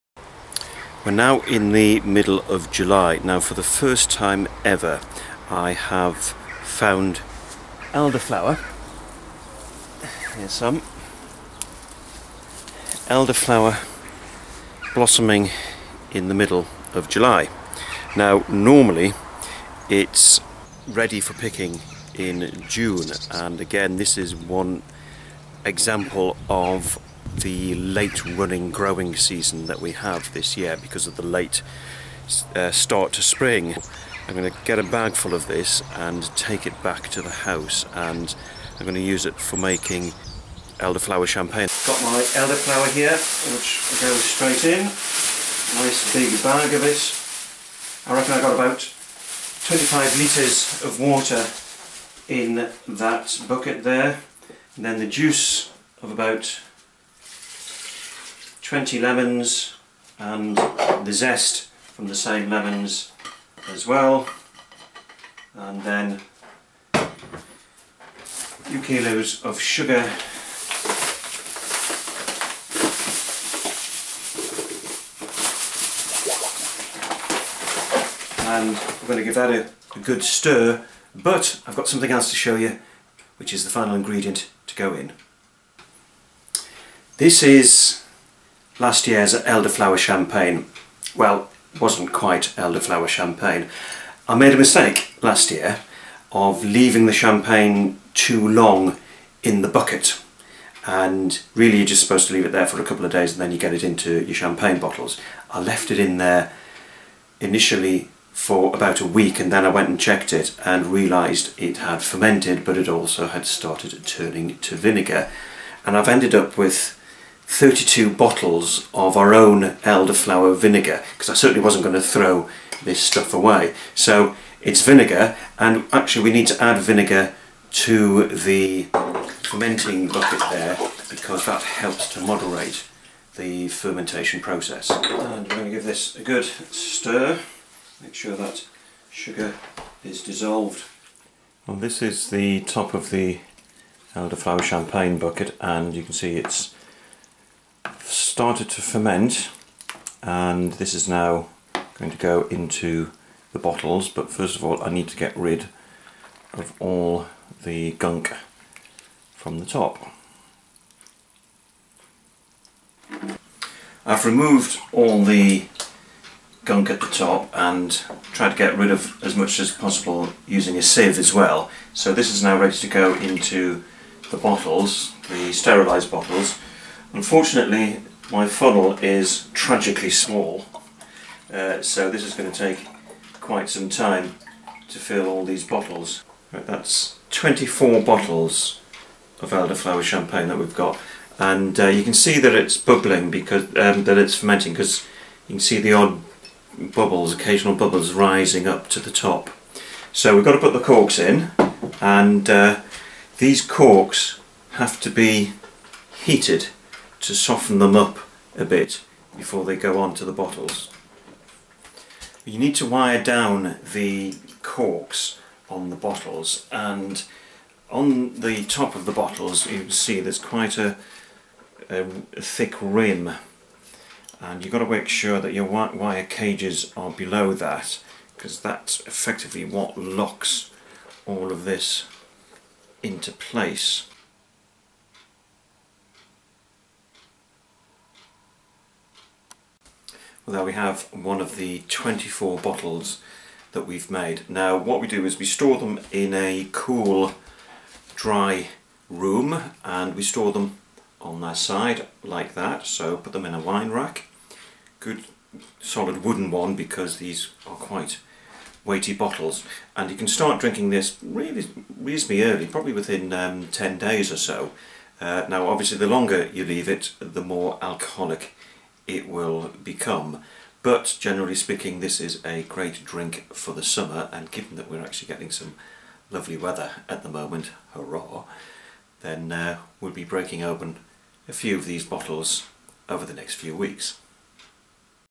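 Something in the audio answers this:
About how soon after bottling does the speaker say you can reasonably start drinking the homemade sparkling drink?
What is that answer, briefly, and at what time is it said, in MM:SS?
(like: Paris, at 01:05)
10 days, at 04:23.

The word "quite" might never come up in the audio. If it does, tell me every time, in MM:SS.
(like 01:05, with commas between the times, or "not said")
01:32, 03:03, 03:40, 04:17.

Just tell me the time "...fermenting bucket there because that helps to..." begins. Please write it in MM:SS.
02:09.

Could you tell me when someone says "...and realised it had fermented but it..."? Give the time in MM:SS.
01:50.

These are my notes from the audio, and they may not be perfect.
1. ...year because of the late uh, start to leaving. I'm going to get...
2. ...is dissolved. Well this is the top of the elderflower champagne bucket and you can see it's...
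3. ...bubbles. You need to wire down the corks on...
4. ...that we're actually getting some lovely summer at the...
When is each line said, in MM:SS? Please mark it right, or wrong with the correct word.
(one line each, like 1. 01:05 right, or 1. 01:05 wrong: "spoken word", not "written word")
1. 00:30 wrong: "spring", not "leaving"
2. 02:20 right
3. 03:30 wrong: "bottles", not "bubbles"
4. 04:34 wrong: "weather", not "summer".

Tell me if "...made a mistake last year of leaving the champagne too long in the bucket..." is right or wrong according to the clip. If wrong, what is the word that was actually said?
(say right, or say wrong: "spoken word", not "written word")
right.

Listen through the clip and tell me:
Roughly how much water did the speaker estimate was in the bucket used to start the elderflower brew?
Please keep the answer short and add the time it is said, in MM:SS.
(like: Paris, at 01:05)
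25 litres, at 00:49.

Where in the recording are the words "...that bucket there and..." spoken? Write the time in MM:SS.
00:52.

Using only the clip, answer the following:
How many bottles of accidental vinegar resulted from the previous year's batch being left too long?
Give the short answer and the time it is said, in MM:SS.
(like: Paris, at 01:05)
32, at 01:57.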